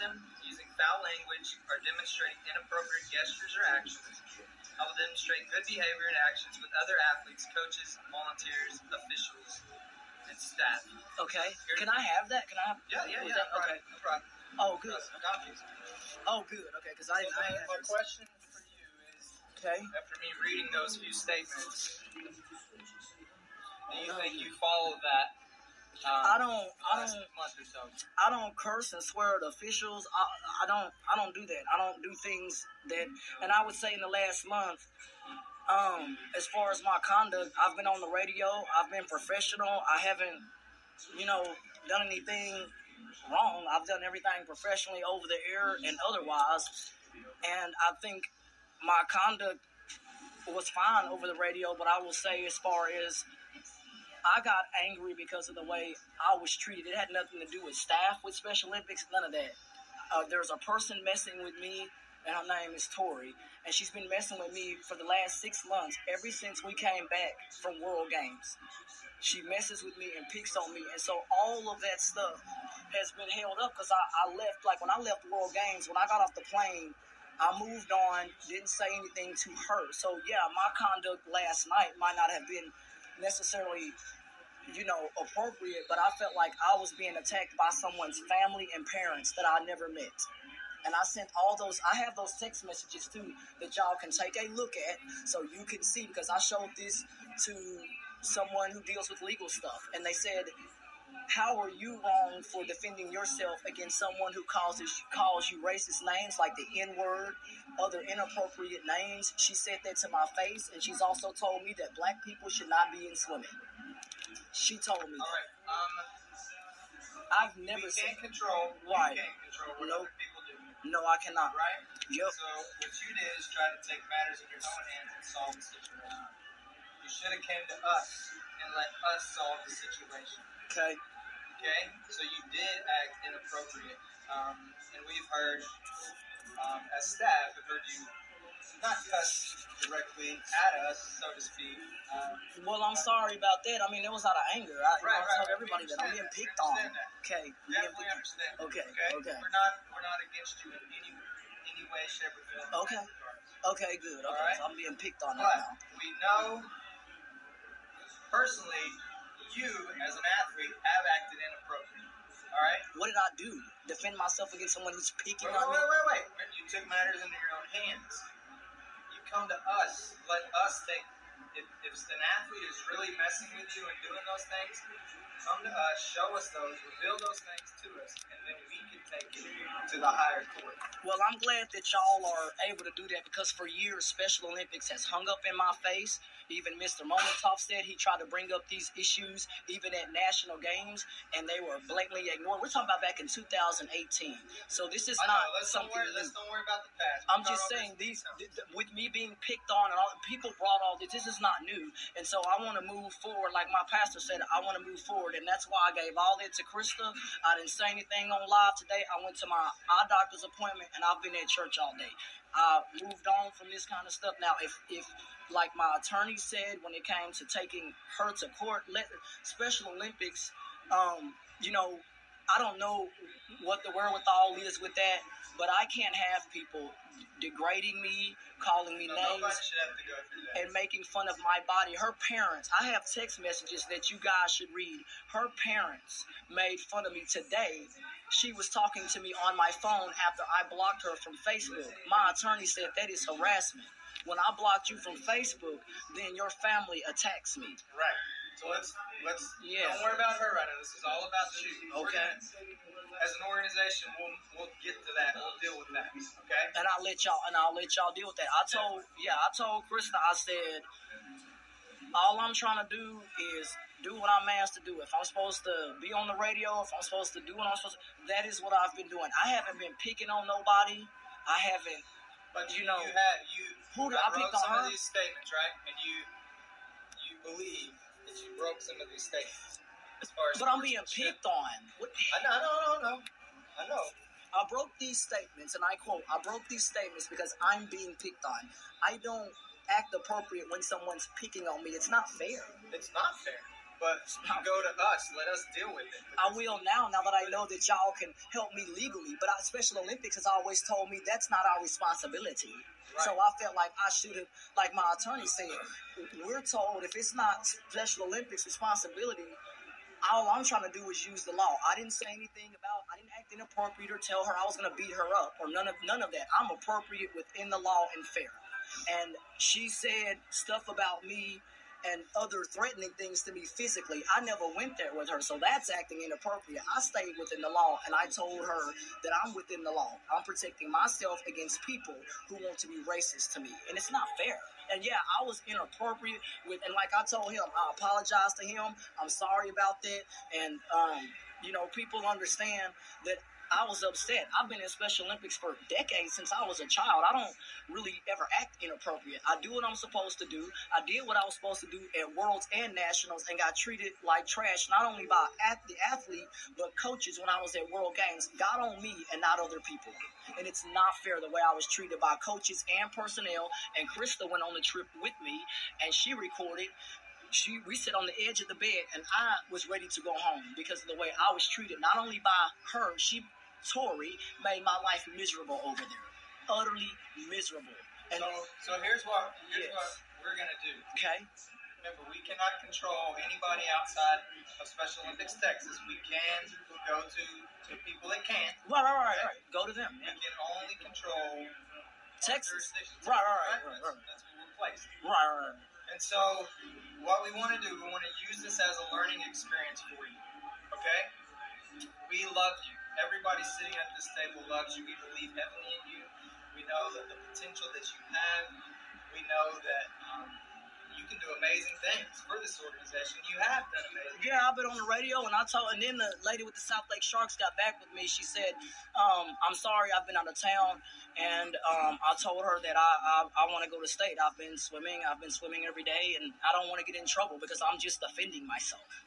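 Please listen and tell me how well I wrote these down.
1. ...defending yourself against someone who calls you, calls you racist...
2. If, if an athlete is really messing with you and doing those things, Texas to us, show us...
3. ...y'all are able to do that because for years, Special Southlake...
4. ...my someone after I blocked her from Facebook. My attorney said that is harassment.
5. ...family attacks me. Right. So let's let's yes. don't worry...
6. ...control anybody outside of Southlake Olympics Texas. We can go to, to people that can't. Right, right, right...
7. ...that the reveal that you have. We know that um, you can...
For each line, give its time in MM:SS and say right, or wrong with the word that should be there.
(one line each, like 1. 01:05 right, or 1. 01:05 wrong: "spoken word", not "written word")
1. 01:42 right
2. 02:51 wrong: "Come", not "Texas"
3. 03:01 wrong: "Olympics", not "Southlake"
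4. 03:59 wrong: "phone", not "someone"
5. 04:06 right
6. 06:22 wrong: "Special", not "Southlake"
7. 06:47 wrong: "potential", not "reveal".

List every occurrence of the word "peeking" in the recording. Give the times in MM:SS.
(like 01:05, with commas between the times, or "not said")
02:45.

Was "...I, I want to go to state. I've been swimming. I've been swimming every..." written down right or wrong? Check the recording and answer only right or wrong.
right.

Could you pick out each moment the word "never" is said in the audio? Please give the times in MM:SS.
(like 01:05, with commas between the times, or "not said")
01:29, 01:57, 05:24.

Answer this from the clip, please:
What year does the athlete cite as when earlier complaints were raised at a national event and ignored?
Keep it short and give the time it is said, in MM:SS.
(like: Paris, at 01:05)
2018, at 03:13.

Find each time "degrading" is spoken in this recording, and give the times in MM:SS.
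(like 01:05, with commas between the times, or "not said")
03:47.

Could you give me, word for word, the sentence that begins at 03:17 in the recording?
I'm just saying these, th- th- with me being picked on and all, people brought all this.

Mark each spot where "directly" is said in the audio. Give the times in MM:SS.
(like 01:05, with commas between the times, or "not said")
02:19.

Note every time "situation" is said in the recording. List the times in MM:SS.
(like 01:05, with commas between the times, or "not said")
02:05, 02:09.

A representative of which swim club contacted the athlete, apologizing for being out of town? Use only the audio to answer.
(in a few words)
Southlake Sharks.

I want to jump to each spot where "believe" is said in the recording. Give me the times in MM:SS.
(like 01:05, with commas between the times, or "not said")
04:37, 06:45.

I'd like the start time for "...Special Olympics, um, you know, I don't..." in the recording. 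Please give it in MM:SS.
03:39.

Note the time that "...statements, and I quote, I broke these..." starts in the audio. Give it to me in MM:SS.
04:45.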